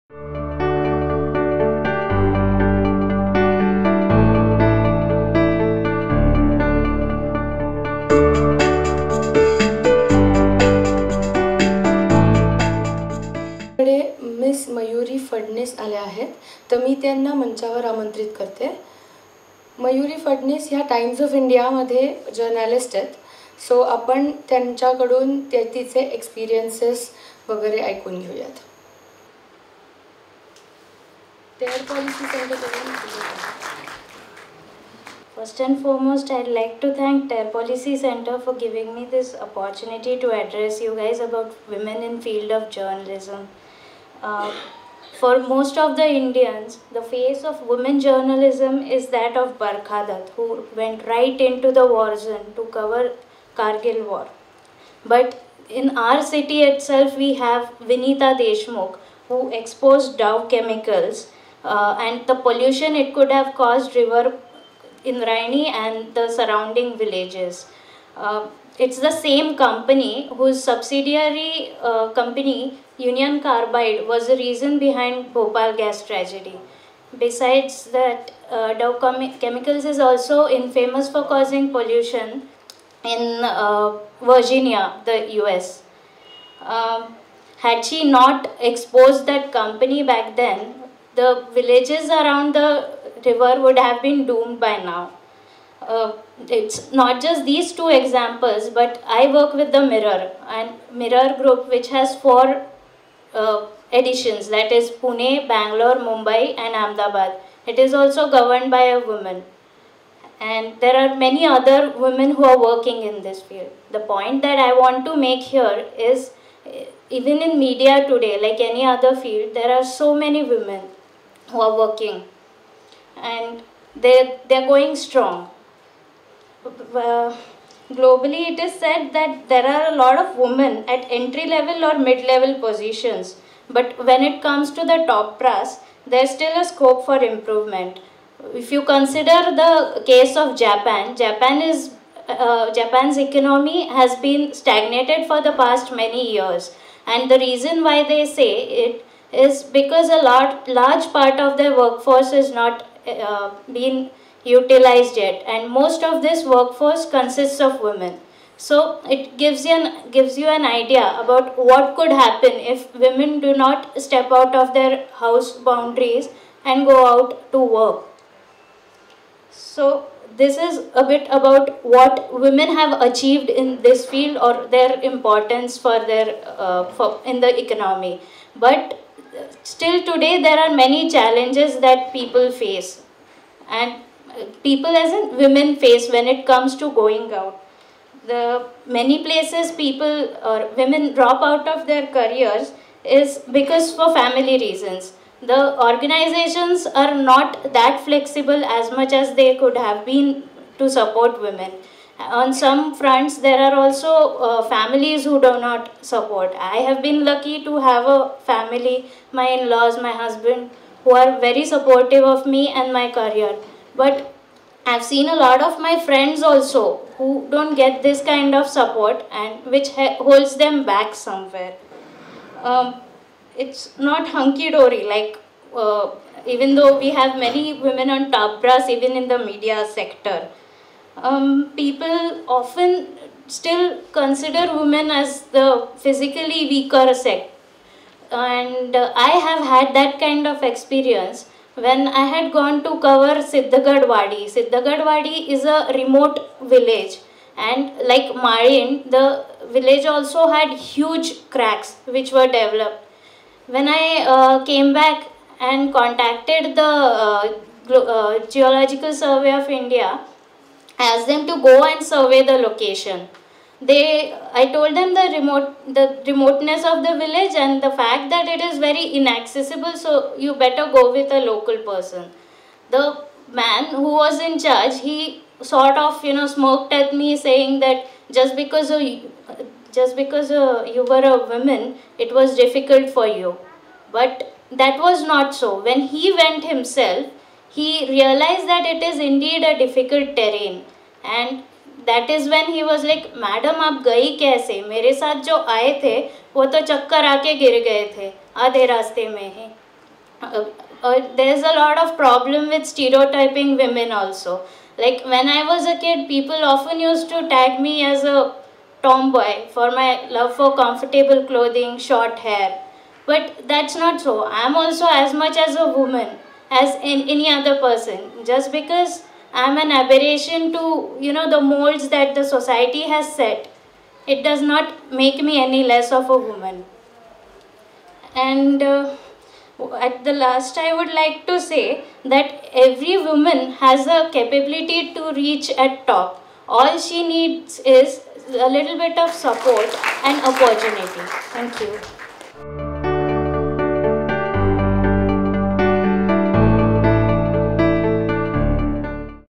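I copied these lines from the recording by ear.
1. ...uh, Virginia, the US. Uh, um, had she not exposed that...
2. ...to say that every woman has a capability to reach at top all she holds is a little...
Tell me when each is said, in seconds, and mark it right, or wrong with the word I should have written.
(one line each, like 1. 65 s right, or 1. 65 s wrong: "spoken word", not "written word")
1. 83 s right
2. 331 s wrong: "needs", not "holds".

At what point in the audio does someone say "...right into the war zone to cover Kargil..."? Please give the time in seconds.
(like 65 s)
51 s.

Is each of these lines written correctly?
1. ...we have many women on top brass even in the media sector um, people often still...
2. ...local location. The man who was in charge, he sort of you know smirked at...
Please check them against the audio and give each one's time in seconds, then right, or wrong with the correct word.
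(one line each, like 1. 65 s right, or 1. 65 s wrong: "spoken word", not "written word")
1. 226 s right
2. 271 s wrong: "person", not "location".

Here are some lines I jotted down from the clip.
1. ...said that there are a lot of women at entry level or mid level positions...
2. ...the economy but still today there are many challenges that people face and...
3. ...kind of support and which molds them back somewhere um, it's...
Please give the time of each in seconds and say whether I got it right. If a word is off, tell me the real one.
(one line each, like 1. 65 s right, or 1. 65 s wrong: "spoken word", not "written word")
1. 128 s right
2. 177 s right
3. 218 s wrong: "holds", not "molds".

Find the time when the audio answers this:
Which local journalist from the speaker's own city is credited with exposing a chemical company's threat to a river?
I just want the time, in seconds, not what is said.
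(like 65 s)
57 s.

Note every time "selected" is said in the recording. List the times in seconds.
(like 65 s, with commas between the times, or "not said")
not said.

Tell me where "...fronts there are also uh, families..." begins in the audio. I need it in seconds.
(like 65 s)
202 s.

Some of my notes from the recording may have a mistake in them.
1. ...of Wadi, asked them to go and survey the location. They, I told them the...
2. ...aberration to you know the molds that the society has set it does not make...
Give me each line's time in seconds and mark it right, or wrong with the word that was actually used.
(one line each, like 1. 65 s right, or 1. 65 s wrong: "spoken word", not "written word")
1. 259 s wrong: "India", not "Wadi"
2. 319 s right.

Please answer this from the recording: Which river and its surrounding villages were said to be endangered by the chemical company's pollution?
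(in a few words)
Indrayani.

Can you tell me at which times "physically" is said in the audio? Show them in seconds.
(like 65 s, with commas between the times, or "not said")
235 s.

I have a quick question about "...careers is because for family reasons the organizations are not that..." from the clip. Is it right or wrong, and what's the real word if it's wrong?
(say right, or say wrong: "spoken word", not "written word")
right.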